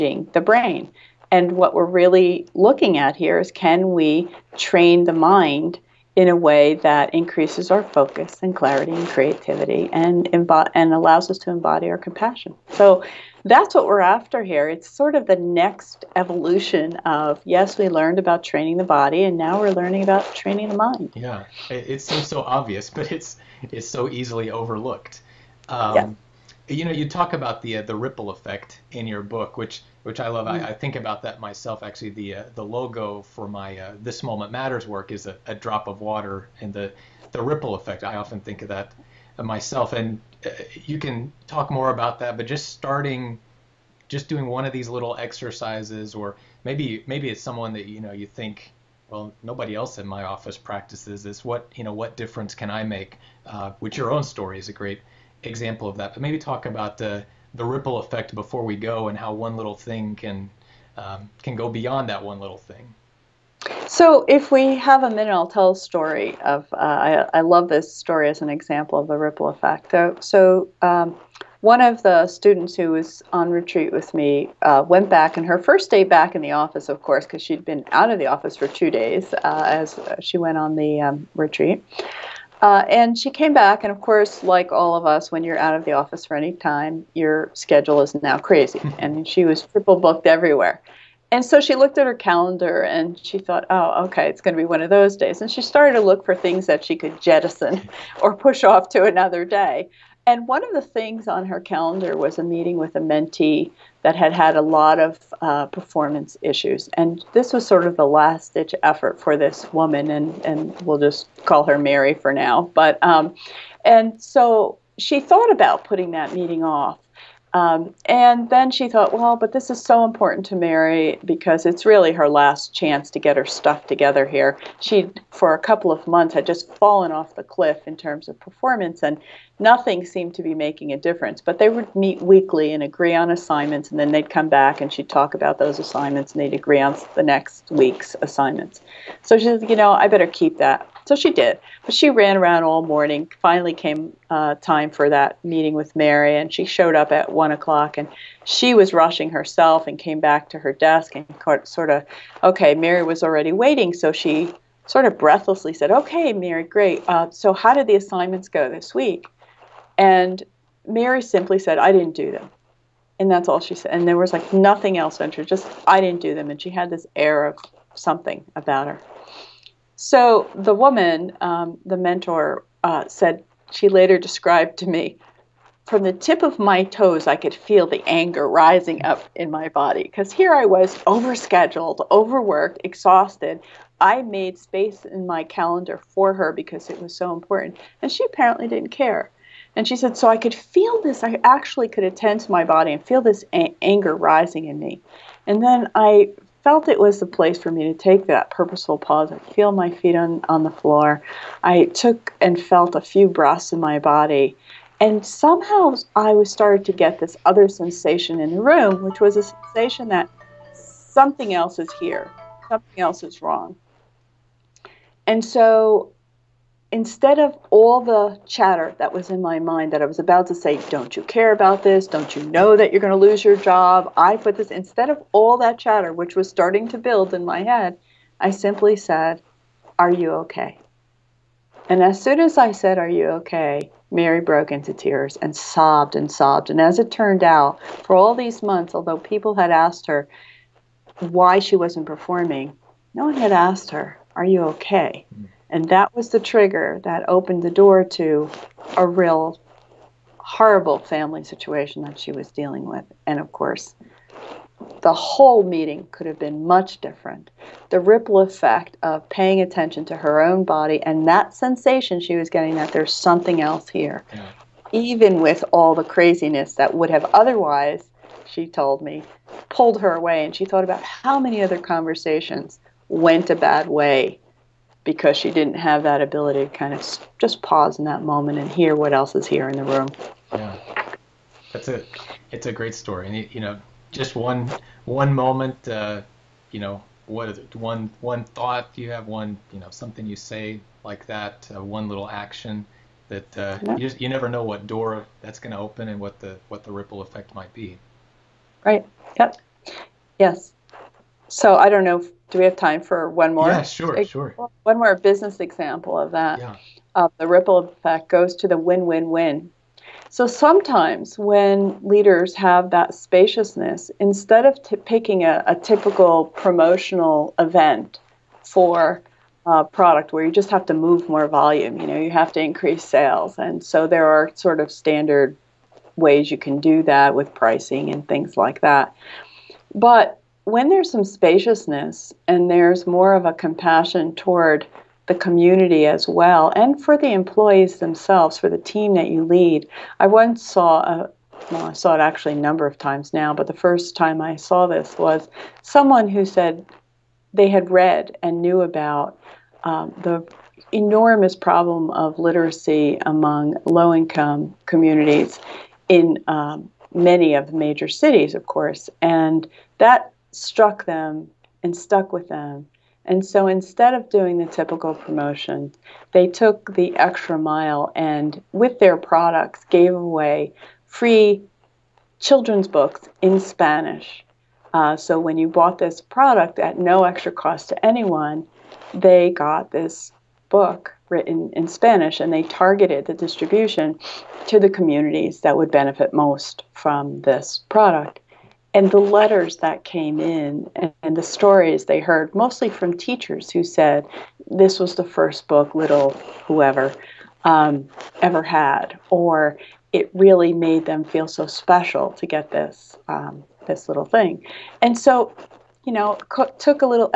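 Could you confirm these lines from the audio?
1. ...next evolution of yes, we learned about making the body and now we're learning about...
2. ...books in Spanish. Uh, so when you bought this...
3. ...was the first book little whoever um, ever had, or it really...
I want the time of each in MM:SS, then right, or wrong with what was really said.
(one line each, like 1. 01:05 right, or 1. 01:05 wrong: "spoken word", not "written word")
1. 00:15 wrong: "training", not "making"
2. 06:12 right
3. 06:34 right.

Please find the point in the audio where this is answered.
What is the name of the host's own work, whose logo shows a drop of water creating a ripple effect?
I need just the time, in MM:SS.
00:34.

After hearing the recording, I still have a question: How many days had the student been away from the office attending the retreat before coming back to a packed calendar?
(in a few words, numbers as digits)
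2.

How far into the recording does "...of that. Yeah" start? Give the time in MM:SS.
05:06.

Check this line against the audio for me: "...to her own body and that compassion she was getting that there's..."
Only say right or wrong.
wrong.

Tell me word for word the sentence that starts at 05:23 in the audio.
And so there are sort of standard ways you can do that with pricing and things like that.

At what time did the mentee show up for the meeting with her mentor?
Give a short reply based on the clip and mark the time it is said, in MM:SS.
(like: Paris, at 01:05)
one o'clock, at 02:27.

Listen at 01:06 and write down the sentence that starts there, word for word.
Uh, I, I, love this story as an example of the ripple effect.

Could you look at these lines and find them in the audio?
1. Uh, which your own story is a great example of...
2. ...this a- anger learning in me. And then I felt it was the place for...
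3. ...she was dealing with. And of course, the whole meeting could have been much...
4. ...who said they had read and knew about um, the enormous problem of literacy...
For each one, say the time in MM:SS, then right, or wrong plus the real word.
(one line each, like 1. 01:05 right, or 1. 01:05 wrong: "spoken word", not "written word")
1. 00:53 right
2. 03:13 wrong: "rising", not "learning"
3. 04:12 right
4. 05:46 right.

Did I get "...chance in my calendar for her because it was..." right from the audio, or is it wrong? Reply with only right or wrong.
wrong.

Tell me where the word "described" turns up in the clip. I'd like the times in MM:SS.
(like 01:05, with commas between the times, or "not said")
02:54.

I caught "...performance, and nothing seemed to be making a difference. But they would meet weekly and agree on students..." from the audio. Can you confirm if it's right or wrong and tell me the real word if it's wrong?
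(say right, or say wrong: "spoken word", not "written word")
wrong: "assignments", not "students".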